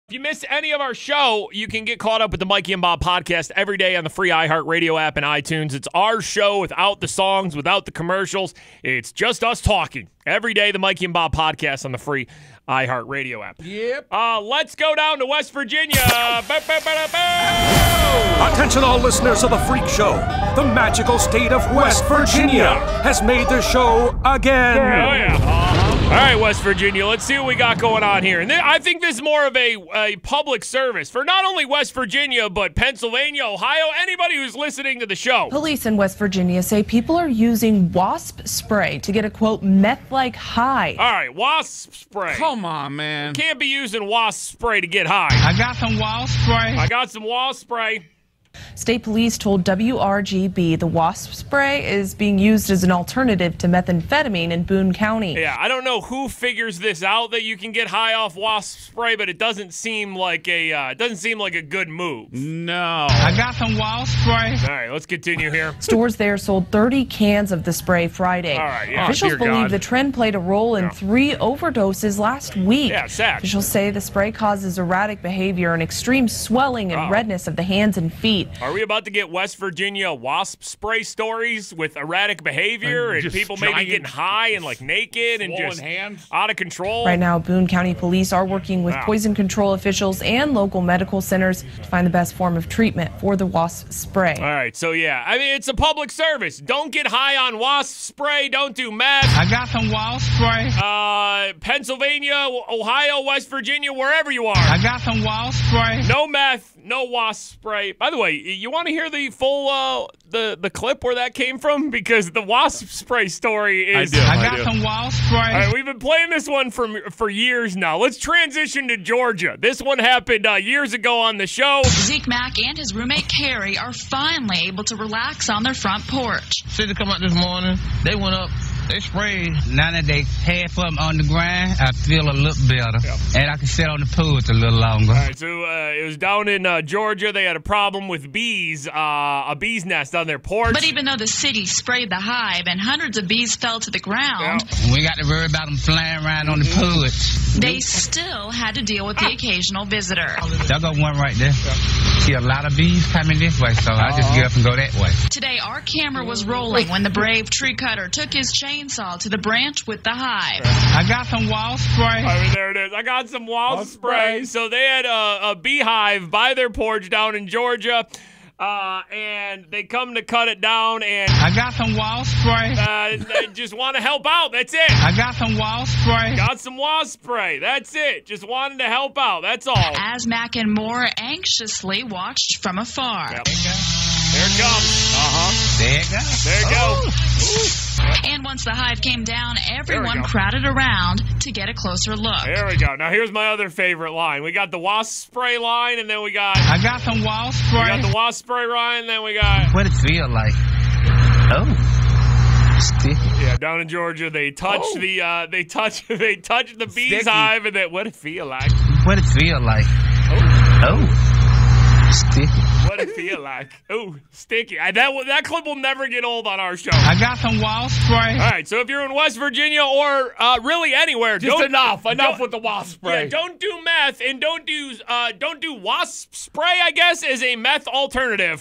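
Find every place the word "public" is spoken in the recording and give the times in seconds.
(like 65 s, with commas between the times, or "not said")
30 s, 95 s.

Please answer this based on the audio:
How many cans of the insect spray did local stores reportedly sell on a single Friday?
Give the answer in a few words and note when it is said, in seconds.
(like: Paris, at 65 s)
30, at 66 s.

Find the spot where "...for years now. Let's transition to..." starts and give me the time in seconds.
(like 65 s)
117 s.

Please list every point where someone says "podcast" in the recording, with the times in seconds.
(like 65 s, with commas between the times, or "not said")
3 s, 11 s.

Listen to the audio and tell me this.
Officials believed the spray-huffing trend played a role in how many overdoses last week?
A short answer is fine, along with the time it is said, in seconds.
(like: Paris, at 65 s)
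3, at 70 s.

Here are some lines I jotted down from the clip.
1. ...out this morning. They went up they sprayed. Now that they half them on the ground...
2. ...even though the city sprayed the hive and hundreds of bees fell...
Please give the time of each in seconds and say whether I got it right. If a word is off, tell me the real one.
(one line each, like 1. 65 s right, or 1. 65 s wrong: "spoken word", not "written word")
1. 127 s right
2. 140 s right.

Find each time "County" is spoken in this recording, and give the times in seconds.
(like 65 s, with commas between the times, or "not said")
54 s, 87 s.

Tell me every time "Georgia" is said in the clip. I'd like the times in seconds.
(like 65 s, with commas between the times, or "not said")
118 s, 136 s, 167 s, 203 s.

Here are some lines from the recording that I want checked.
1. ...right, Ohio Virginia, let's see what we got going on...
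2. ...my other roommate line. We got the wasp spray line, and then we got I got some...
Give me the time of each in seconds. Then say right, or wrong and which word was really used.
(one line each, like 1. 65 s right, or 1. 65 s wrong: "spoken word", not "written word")
1. 26 s wrong: "West", not "Ohio"
2. 193 s wrong: "favorite", not "roommate".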